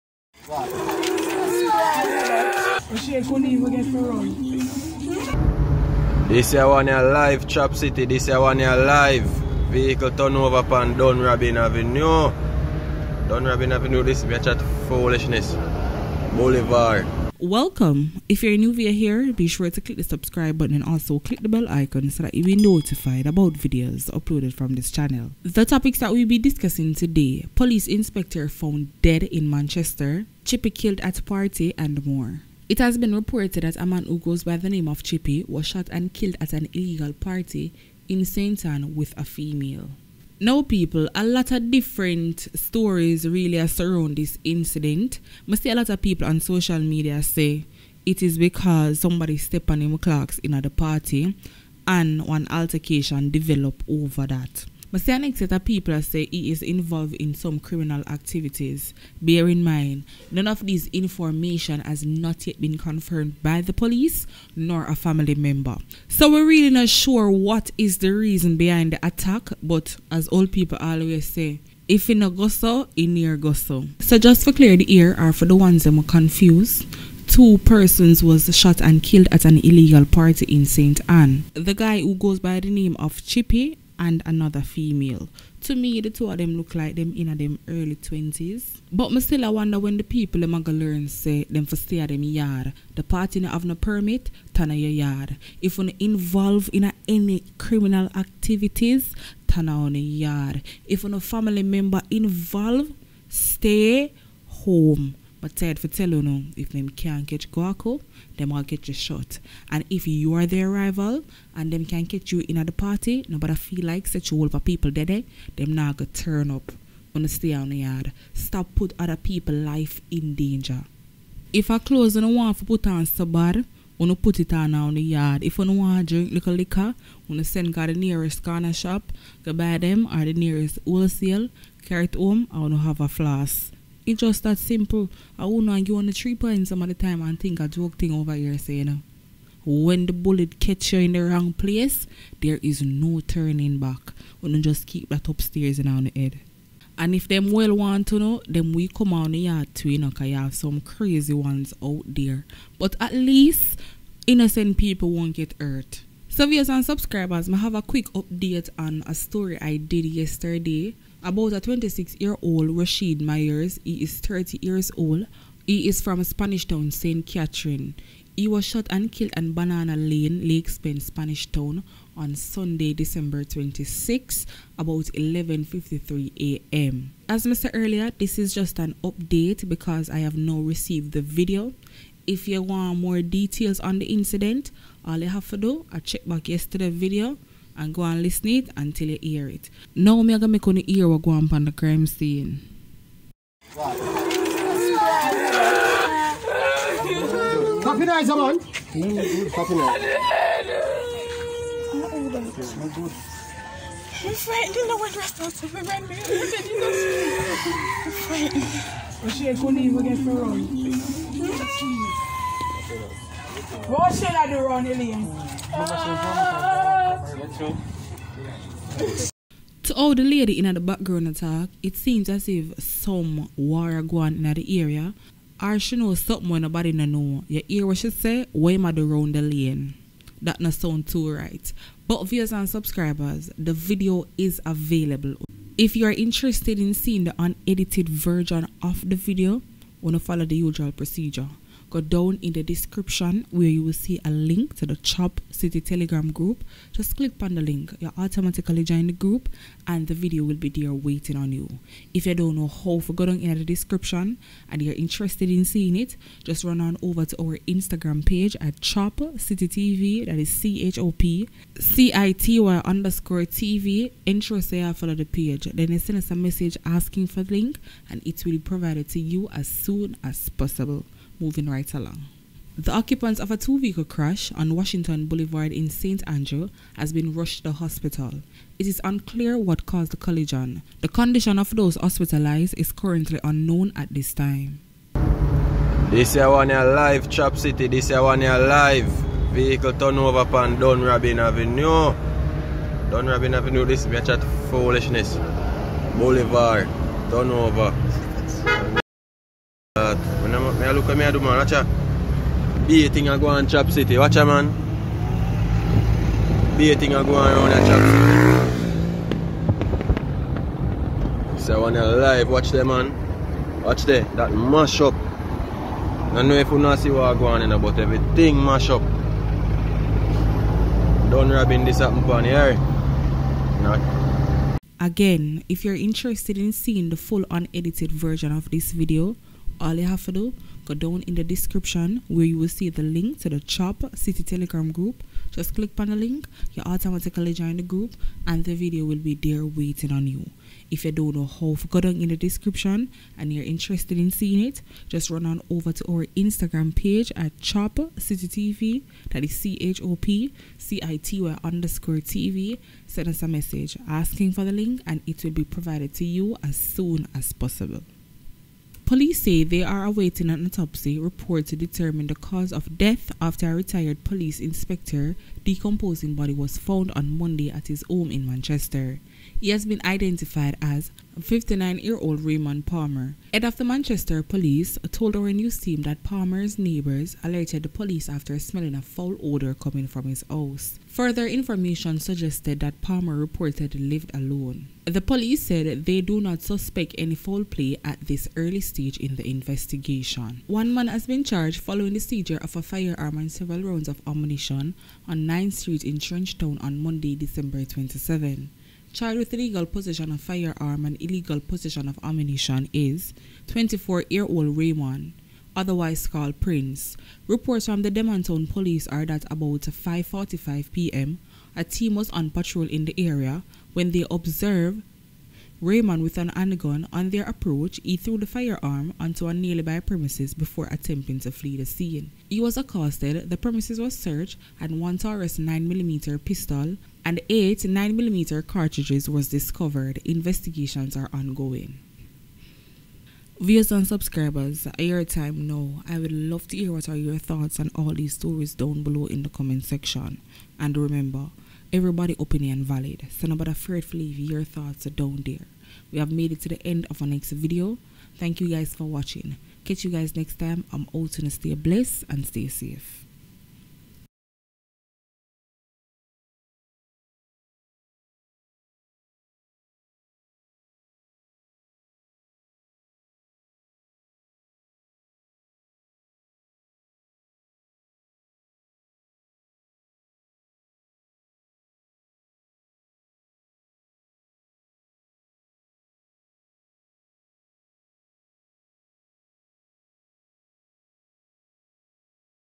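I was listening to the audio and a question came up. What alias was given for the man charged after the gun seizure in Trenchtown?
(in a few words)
Prince.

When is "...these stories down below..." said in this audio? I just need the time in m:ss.
7:18.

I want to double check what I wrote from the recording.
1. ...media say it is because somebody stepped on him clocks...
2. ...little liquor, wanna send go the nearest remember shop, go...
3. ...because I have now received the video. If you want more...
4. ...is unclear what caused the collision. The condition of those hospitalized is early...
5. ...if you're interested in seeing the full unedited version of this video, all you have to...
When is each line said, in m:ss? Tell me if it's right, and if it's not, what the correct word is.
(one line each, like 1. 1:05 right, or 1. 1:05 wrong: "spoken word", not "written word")
1. 0:46 right
2. 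2:06 wrong: "corner", not "remember"
3. 2:59 right
4. 4:38 wrong: "currently", not "early"
5. 5:25 right.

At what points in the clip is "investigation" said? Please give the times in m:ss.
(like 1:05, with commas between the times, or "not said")
6:29, 7:10.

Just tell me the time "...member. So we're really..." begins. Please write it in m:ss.
1:05.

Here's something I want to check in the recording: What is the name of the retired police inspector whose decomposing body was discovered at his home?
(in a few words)
Raymond Palmer.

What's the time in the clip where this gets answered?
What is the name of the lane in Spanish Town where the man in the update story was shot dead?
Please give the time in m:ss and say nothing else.
2:49.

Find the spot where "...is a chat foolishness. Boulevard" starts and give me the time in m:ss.
0:14.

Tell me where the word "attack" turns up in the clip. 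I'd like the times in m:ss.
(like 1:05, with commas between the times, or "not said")
1:09, 3:41.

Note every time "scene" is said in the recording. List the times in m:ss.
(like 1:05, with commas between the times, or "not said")
3:12, 7:01.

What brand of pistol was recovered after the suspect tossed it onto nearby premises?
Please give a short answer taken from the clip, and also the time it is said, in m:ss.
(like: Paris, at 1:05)
Taurus, at 7:05.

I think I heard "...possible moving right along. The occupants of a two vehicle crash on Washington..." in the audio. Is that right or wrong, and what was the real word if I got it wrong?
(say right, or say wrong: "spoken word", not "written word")
right.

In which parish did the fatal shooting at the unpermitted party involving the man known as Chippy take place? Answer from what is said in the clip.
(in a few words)
St. Anne.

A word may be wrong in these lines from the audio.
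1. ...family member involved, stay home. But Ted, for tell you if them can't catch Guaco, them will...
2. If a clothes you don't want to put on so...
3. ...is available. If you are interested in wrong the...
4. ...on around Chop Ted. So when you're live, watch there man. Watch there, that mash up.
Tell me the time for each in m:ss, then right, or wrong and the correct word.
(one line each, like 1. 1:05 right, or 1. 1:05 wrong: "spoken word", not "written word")
1. 1:41 right
2. 2:01 right
3. 3:54 wrong: "seeing", not "wrong"
4. 5:07 wrong: "City", not "Ted".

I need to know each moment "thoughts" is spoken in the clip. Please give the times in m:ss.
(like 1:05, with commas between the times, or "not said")
7:17, 7:24.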